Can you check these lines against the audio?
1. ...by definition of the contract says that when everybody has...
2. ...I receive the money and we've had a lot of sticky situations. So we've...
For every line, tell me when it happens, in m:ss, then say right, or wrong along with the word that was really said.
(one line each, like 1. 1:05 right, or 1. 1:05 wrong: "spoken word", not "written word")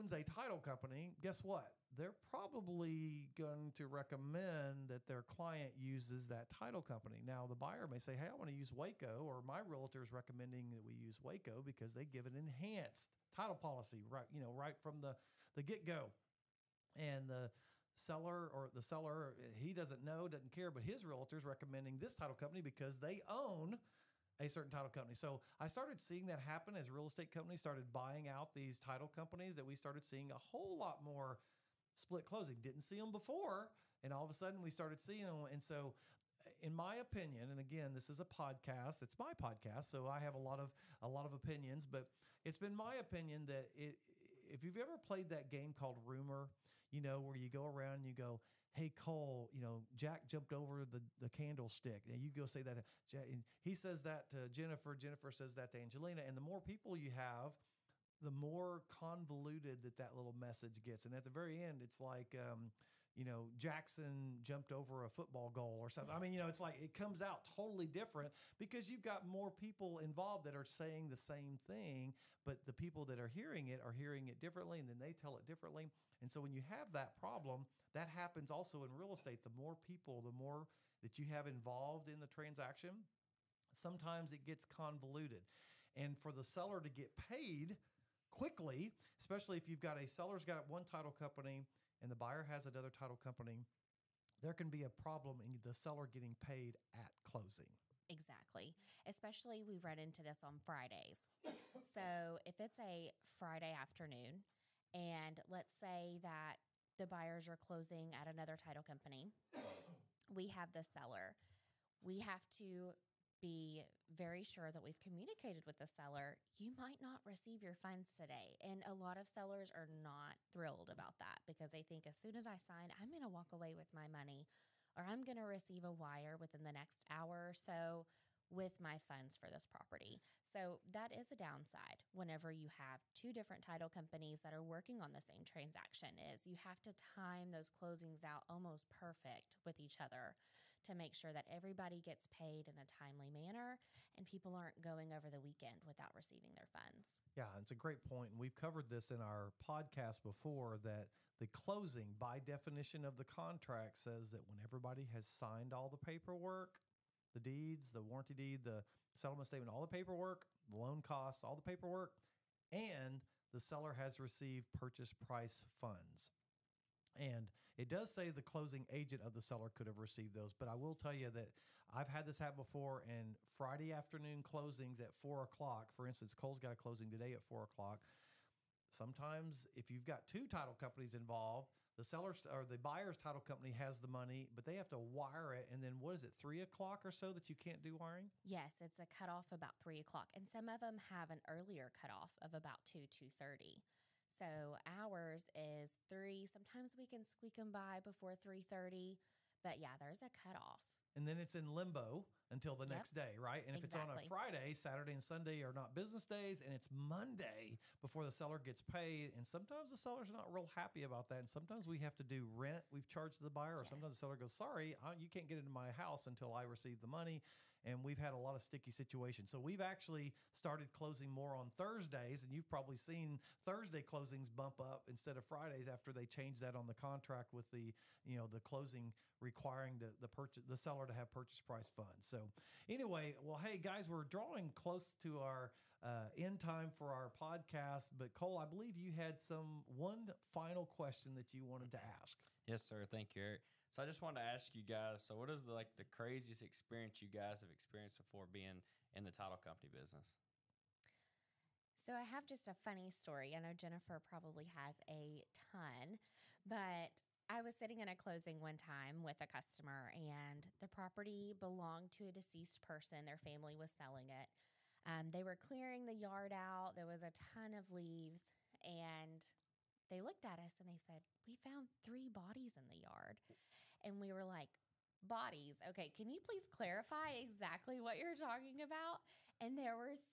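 1. 2:32 right
2. 3:36 right.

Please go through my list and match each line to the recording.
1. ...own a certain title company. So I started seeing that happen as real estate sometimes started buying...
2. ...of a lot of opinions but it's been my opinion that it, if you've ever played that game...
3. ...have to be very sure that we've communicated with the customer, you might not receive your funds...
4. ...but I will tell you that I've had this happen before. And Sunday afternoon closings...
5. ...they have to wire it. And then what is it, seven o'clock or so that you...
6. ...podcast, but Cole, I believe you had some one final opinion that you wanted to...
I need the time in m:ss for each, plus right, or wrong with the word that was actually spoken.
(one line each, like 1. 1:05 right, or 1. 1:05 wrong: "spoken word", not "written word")
1. 0:23 wrong: "companies", not "sometimes"
2. 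0:40 right
3. 1:52 wrong: "seller", not "customer"
4. 2:50 wrong: "Friday", not "Sunday"
5. 3:04 wrong: "three", not "seven"
6. 3:57 wrong: "question", not "opinion".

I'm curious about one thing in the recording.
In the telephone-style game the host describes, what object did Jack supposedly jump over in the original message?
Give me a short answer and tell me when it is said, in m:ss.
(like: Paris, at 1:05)
the candlestick, at 0:51.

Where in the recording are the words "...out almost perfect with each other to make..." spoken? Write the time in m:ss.
2:18.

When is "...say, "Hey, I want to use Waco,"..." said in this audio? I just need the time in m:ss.
0:07.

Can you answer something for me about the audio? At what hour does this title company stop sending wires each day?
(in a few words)
3.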